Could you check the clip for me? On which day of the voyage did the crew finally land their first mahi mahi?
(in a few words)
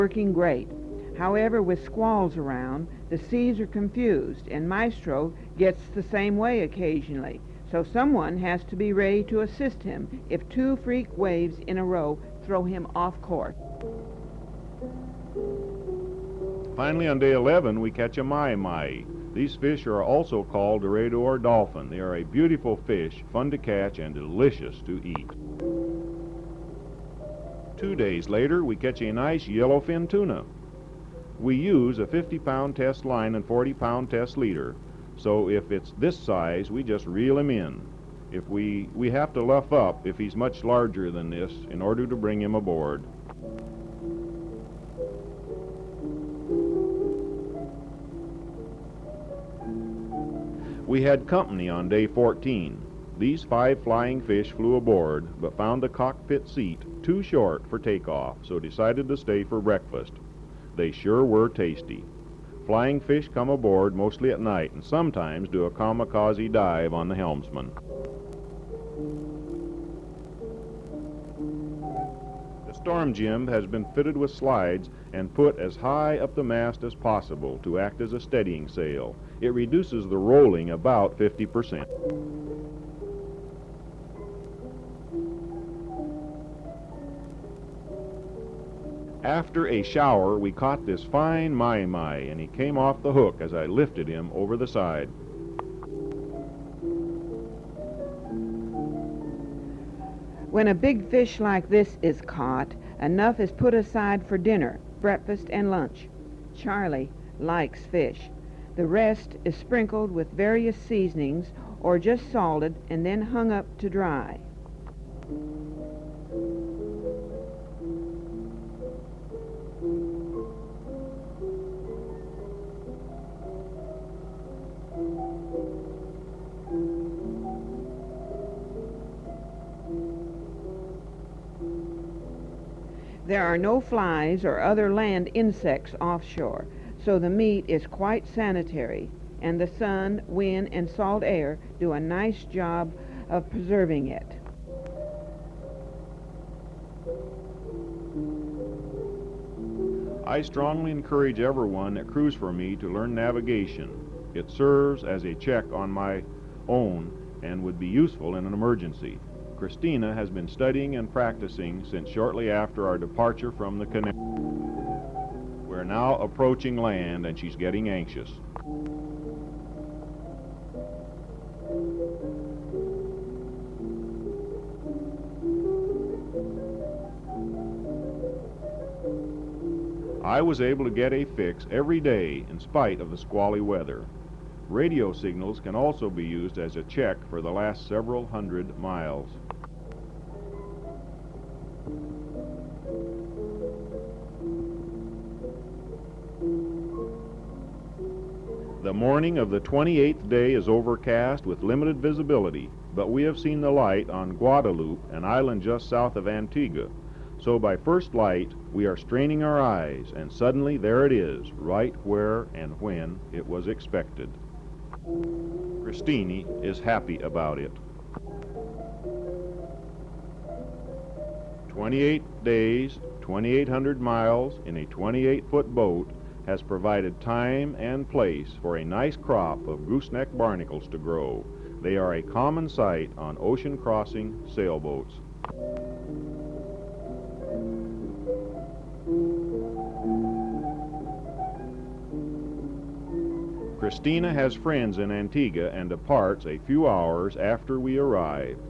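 Day 11.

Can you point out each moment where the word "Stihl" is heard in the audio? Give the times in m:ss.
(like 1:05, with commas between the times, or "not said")
not said.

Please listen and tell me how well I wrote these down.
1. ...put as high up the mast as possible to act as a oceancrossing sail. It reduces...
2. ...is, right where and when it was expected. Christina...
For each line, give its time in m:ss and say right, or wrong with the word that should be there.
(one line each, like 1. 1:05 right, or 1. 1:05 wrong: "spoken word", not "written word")
1. 1:15 wrong: "steadying", not "oceancrossing"
2. 3:31 right.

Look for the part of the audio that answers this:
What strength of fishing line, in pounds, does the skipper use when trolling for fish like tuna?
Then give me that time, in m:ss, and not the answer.
0:32.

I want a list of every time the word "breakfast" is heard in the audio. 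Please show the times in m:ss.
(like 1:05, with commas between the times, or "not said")
0:59, 1:45.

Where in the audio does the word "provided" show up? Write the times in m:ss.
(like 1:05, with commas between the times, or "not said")
3:46.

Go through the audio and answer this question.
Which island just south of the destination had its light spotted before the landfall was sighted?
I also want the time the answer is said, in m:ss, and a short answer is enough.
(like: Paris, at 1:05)
Guadeloupe, at 3:24.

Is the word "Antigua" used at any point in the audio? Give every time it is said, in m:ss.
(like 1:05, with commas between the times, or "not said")
3:26, 4:05.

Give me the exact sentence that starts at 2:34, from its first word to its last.
It serves as a check on my own and would be useful in an emergency.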